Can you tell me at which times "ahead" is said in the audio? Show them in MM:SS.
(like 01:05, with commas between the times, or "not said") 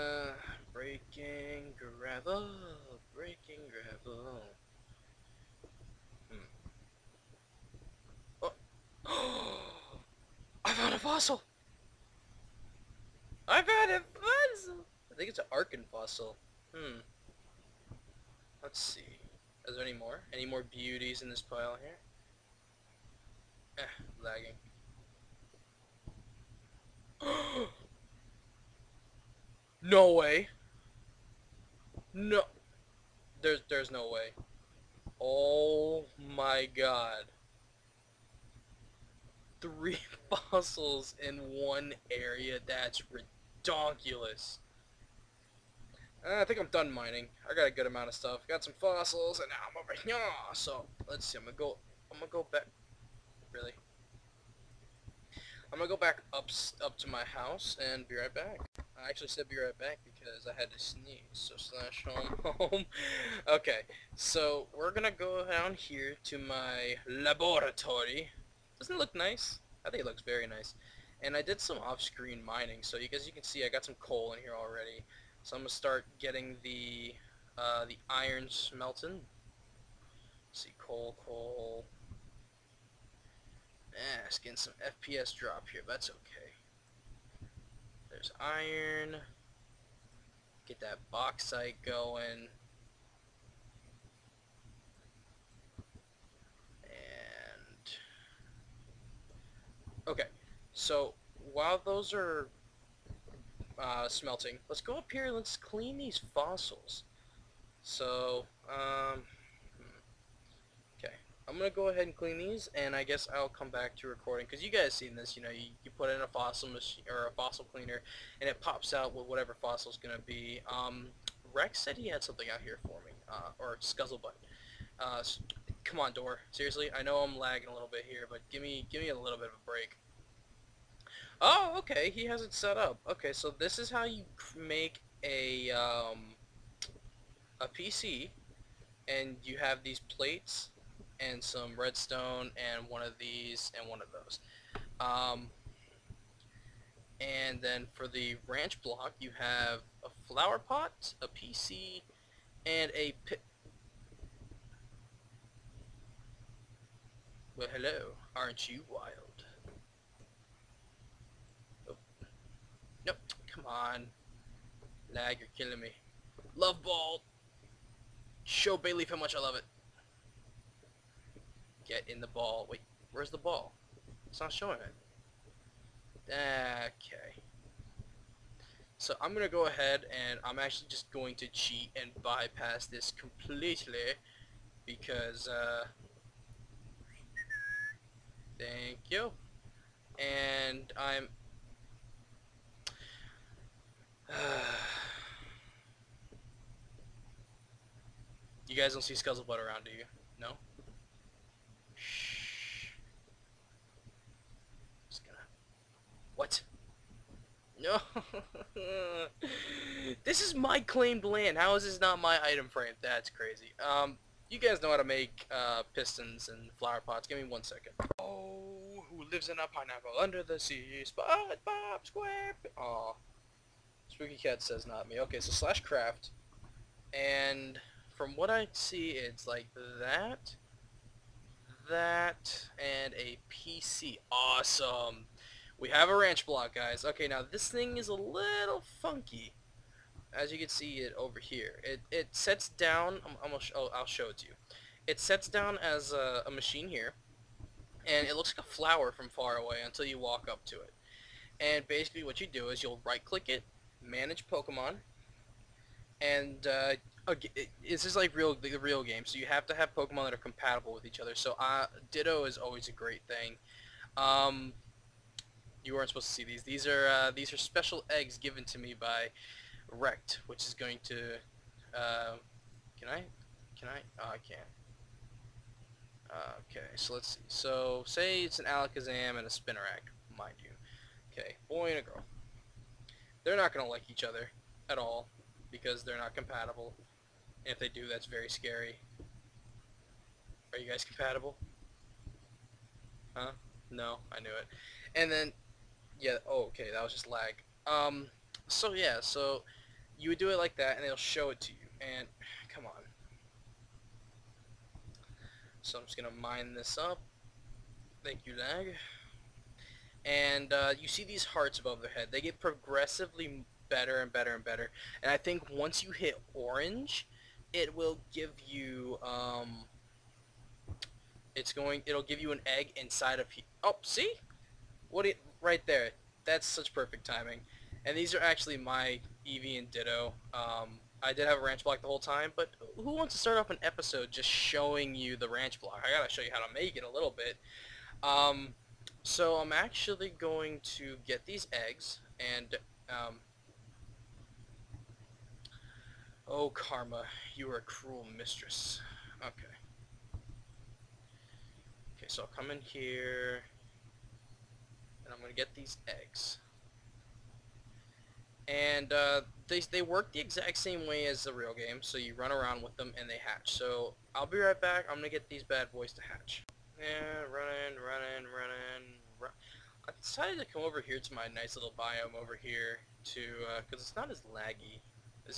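01:51, 02:59.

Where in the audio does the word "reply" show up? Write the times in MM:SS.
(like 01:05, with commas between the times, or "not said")
not said.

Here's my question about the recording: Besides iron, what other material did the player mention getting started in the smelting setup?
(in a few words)
bauxite.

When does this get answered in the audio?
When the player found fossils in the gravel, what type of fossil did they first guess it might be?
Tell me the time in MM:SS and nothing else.
00:15.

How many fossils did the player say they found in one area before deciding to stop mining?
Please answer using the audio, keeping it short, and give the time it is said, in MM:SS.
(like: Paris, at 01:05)
3, at 00:39.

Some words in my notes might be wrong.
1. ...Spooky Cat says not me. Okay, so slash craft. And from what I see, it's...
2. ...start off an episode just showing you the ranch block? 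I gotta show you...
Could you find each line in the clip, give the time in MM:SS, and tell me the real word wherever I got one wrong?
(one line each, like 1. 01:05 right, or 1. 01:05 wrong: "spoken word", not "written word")
1. 03:44 right
2. 05:33 right.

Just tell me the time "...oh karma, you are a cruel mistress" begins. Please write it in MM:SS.
05:46.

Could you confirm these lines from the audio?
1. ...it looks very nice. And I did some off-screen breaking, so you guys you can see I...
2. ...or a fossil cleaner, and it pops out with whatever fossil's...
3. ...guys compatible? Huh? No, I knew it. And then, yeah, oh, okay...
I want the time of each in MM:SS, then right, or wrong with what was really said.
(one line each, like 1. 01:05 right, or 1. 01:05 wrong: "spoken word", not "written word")
1. 01:10 wrong: "mining", not "breaking"
2. 01:57 right
3. 04:50 right.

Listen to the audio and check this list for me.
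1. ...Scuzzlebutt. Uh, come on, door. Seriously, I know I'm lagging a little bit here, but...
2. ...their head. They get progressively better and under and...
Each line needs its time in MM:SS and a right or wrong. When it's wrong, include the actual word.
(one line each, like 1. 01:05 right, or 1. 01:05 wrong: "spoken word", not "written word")
1. 02:03 right
2. 05:12 wrong: "better", not "under".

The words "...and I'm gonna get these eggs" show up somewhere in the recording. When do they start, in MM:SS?
05:55.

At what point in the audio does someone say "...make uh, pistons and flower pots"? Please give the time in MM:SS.
03:35.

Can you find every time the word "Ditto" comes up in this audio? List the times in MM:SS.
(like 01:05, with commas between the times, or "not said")
04:22, 05:29.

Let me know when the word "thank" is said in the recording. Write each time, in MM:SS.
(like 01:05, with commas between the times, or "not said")
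03:08, 05:08.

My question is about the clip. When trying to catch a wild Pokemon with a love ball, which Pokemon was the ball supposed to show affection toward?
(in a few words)
Bayleef.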